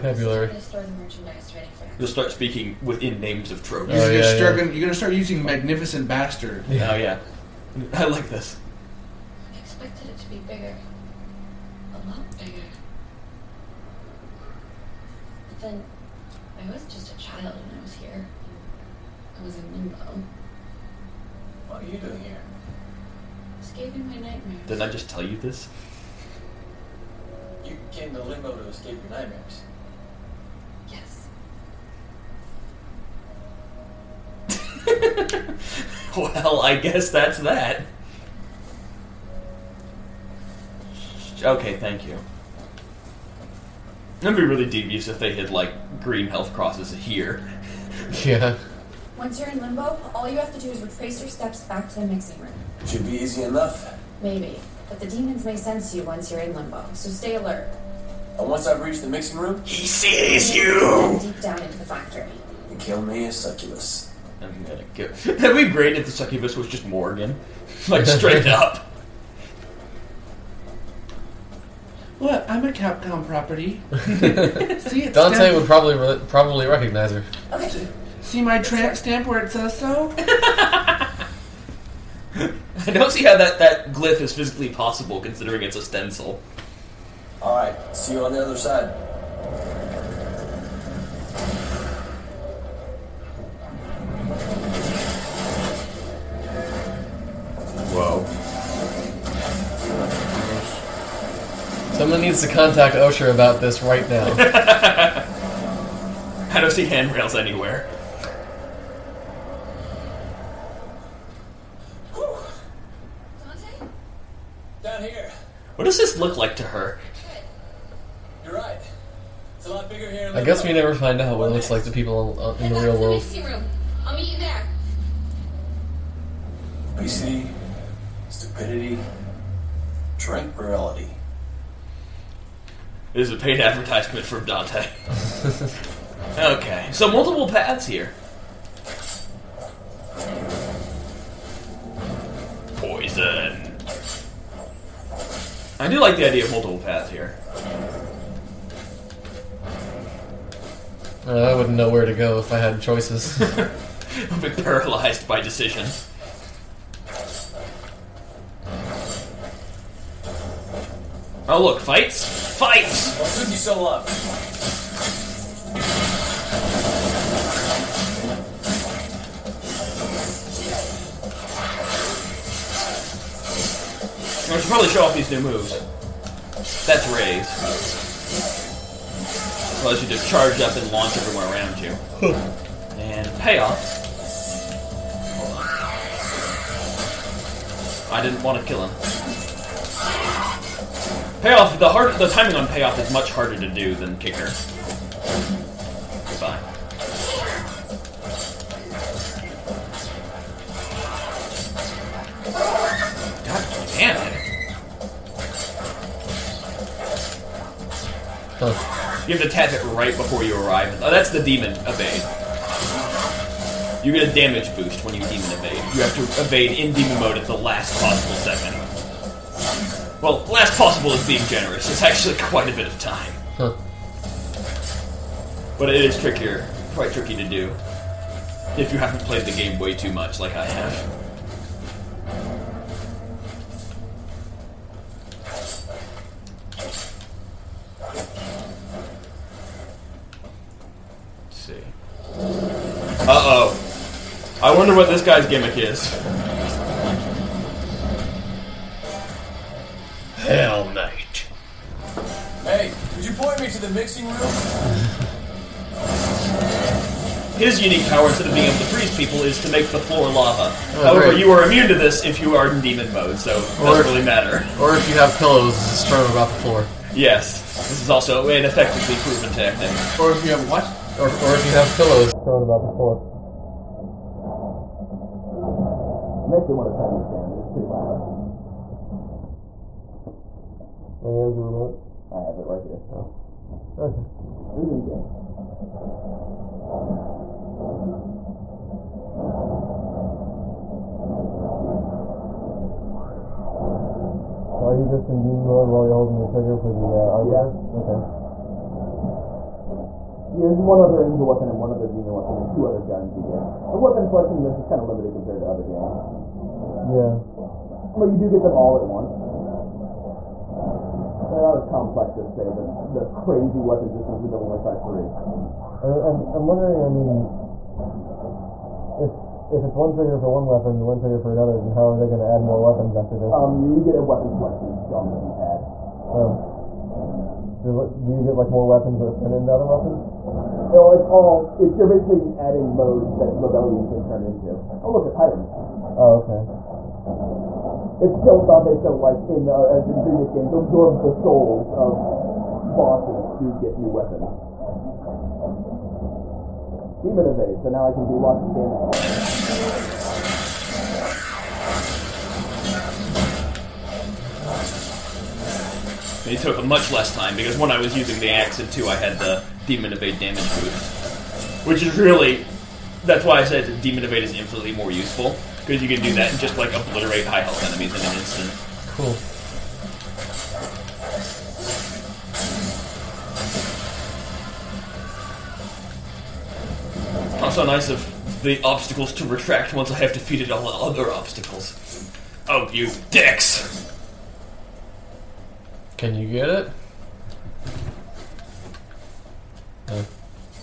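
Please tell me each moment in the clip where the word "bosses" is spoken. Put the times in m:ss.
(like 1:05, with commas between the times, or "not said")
5:42.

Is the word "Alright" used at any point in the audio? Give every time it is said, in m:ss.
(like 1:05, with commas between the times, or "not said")
1:27.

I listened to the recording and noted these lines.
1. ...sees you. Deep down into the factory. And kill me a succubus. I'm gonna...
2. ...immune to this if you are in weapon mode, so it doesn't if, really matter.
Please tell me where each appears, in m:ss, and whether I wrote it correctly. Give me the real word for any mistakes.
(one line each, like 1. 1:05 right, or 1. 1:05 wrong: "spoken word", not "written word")
1. 0:59 right
2. 4:21 wrong: "demon", not "weapon".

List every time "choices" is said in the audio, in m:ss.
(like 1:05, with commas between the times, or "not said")
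2:32.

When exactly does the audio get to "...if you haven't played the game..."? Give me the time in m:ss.
3:48.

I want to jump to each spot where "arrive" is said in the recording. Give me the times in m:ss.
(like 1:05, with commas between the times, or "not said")
3:30.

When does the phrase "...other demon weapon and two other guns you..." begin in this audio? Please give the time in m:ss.
5:01.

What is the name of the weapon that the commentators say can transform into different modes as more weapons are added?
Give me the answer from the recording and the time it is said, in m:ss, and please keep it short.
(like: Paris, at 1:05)
Rebellion, at 5:33.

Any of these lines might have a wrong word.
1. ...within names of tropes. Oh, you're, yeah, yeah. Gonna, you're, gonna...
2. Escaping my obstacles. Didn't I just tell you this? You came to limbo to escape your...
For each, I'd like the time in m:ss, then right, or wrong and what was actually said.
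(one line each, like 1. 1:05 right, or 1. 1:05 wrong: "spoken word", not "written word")
1. 0:02 right
2. 0:23 wrong: "nightmares", not "obstacles".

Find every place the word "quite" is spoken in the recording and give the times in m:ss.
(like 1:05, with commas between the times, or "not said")
3:42, 3:46.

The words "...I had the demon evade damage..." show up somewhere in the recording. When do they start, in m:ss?
5:59.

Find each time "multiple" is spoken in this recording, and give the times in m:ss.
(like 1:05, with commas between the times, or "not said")
2:17, 2:26.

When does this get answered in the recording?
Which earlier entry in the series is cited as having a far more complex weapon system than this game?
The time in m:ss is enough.
5:14.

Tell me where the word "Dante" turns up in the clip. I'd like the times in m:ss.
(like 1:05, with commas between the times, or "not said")
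1:15, 2:14, 5:38.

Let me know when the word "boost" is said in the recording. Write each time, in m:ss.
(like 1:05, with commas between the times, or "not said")
3:34, 6:00.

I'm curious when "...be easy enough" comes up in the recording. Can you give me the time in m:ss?
0:53.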